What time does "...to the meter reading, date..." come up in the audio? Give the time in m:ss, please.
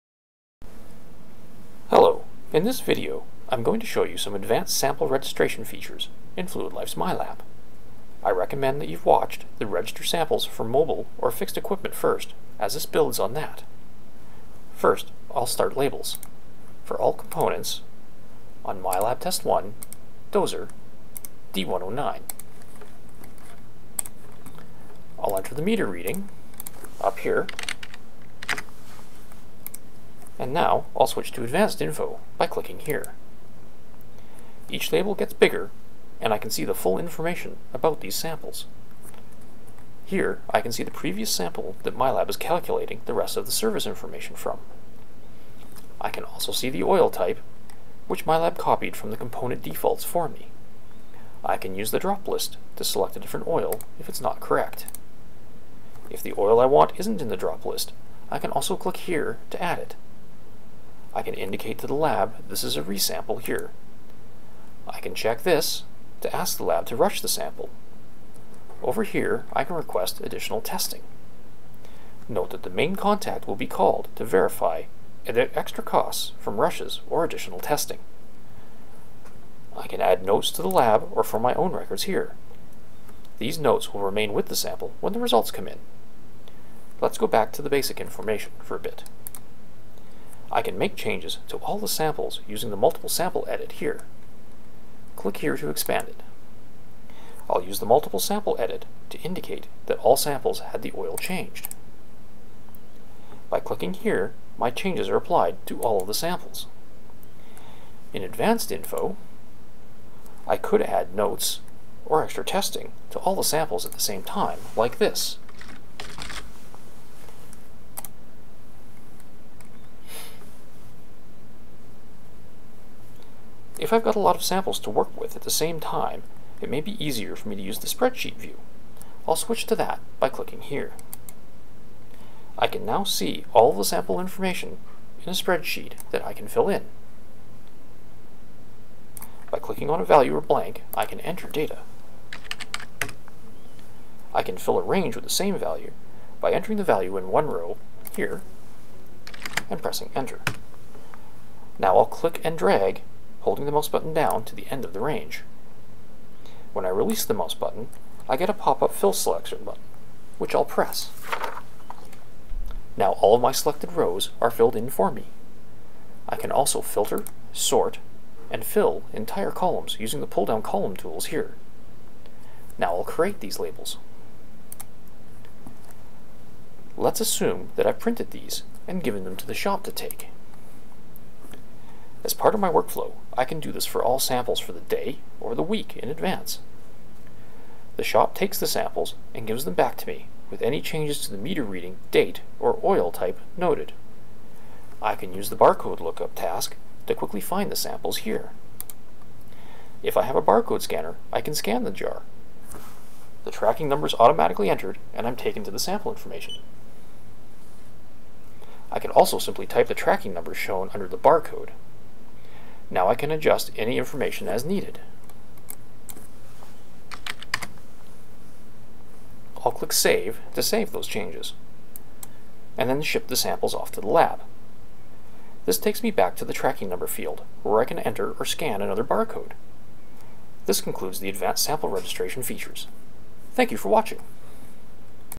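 3:11.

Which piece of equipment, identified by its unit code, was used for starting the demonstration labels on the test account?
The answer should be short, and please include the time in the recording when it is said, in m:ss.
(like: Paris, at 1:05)
Dozer D109, at 0:20.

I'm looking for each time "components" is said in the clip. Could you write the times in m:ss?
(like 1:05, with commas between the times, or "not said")
0:17, 0:49.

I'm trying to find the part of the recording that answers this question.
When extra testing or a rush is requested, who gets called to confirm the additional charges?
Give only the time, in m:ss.
1:12.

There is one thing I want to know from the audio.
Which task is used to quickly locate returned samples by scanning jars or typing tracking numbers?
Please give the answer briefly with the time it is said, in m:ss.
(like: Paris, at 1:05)
Barcode lookup, at 3:15.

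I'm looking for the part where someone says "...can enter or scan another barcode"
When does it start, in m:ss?
3:47.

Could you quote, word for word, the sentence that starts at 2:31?
Now I'll click and drag holding the mouse button down to the end of the range.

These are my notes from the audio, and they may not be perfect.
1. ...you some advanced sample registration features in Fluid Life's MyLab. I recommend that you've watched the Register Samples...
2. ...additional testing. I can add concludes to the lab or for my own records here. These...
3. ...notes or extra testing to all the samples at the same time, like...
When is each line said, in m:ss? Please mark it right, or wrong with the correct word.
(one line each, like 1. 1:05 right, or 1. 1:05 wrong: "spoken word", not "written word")
1. 0:04 right
2. 1:17 wrong: "notes", not "concludes"
3. 1:51 right.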